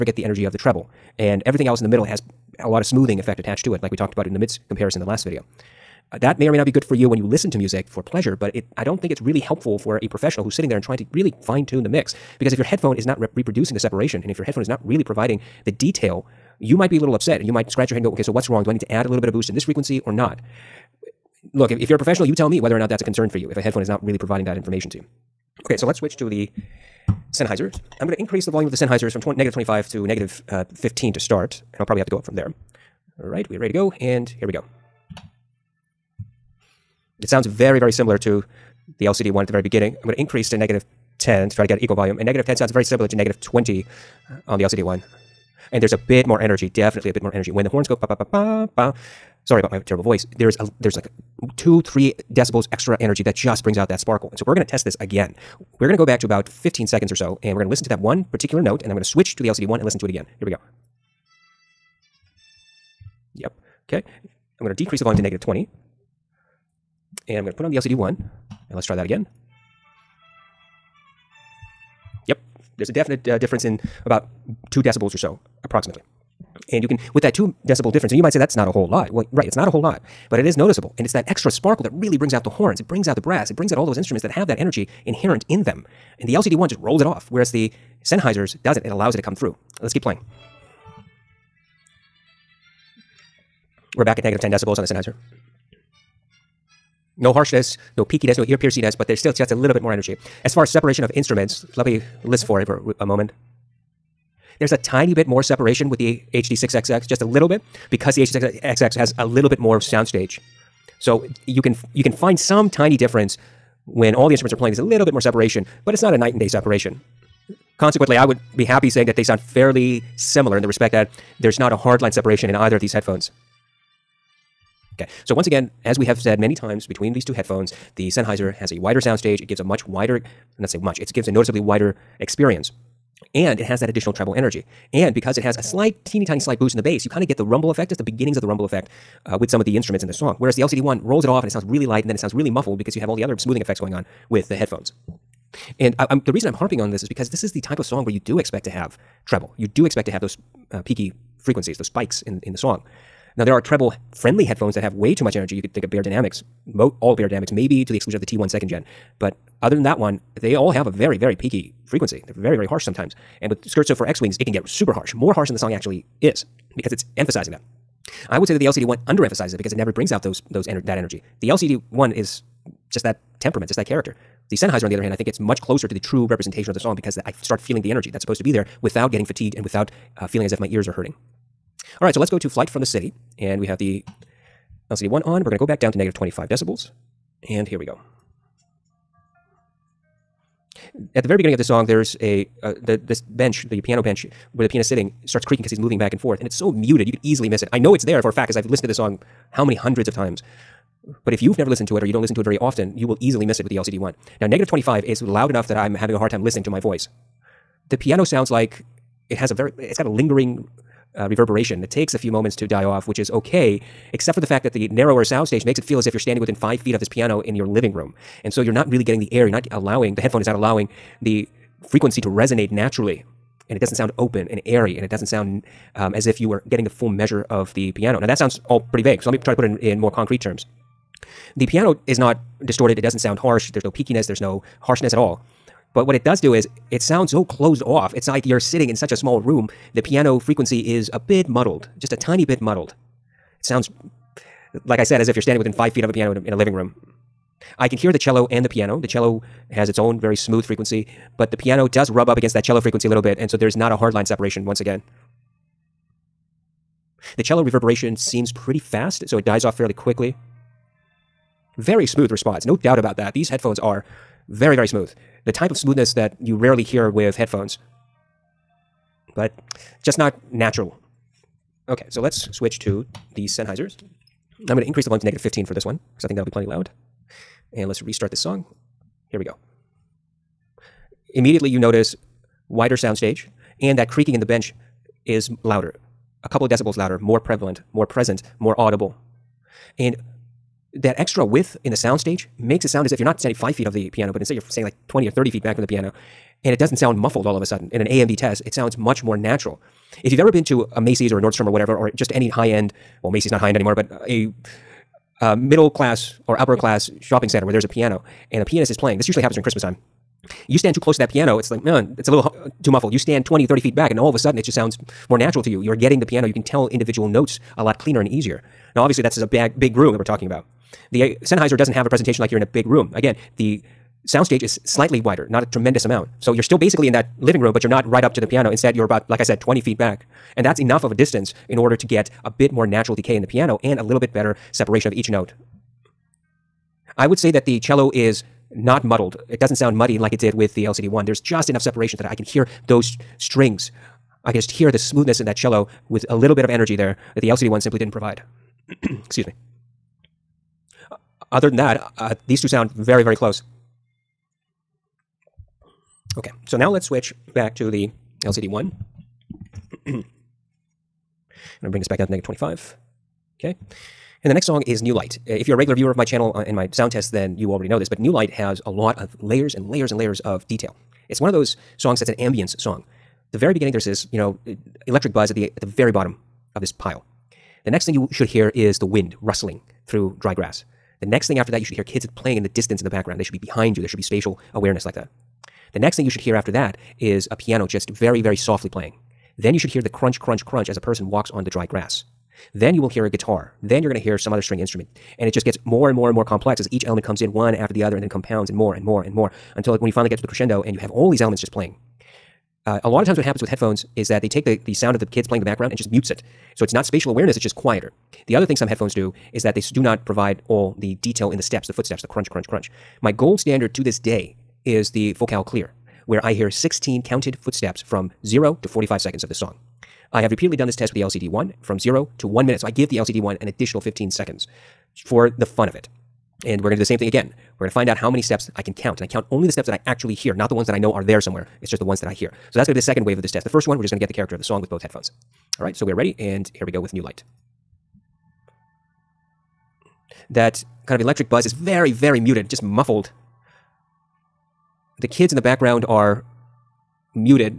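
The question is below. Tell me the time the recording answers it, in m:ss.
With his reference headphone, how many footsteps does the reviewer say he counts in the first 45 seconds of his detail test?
6:56.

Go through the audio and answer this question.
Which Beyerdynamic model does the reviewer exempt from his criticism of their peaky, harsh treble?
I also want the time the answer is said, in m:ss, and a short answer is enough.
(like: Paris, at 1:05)
T1 second gen, at 2:38.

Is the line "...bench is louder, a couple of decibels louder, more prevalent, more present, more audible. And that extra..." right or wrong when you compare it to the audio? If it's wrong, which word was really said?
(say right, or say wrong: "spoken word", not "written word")
right.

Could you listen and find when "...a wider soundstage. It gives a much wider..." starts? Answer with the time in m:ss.
2:08.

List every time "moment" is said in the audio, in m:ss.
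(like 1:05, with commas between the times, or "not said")
1:43, 3:32.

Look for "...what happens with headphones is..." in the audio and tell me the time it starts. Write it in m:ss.
6:43.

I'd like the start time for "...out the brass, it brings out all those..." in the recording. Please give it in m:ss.
1:23.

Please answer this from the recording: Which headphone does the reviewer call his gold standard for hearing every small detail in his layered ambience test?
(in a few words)
Focal Clear.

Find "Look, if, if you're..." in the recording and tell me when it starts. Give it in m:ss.
0:21.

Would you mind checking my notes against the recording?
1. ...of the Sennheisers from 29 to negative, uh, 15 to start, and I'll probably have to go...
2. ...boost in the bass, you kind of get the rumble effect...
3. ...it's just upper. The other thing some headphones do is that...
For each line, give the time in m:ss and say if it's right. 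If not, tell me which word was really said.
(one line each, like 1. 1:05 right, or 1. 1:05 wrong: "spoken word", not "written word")
1. 0:28 wrong: "25", not "29"
2. 2:16 right
3. 6:47 wrong: "quieter", not "upper".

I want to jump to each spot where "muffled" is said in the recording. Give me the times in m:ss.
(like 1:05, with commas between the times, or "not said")
2:22, 4:57, 5:12, 7:22.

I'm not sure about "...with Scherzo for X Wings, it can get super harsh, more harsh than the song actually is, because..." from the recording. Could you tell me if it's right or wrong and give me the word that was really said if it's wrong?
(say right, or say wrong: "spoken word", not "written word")
right.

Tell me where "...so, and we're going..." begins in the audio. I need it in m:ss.
0:57.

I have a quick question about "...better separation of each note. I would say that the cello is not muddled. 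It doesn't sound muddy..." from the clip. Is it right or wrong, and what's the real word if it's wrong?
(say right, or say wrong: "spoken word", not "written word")
right.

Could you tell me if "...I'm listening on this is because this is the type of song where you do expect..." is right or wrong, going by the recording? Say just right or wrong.
wrong.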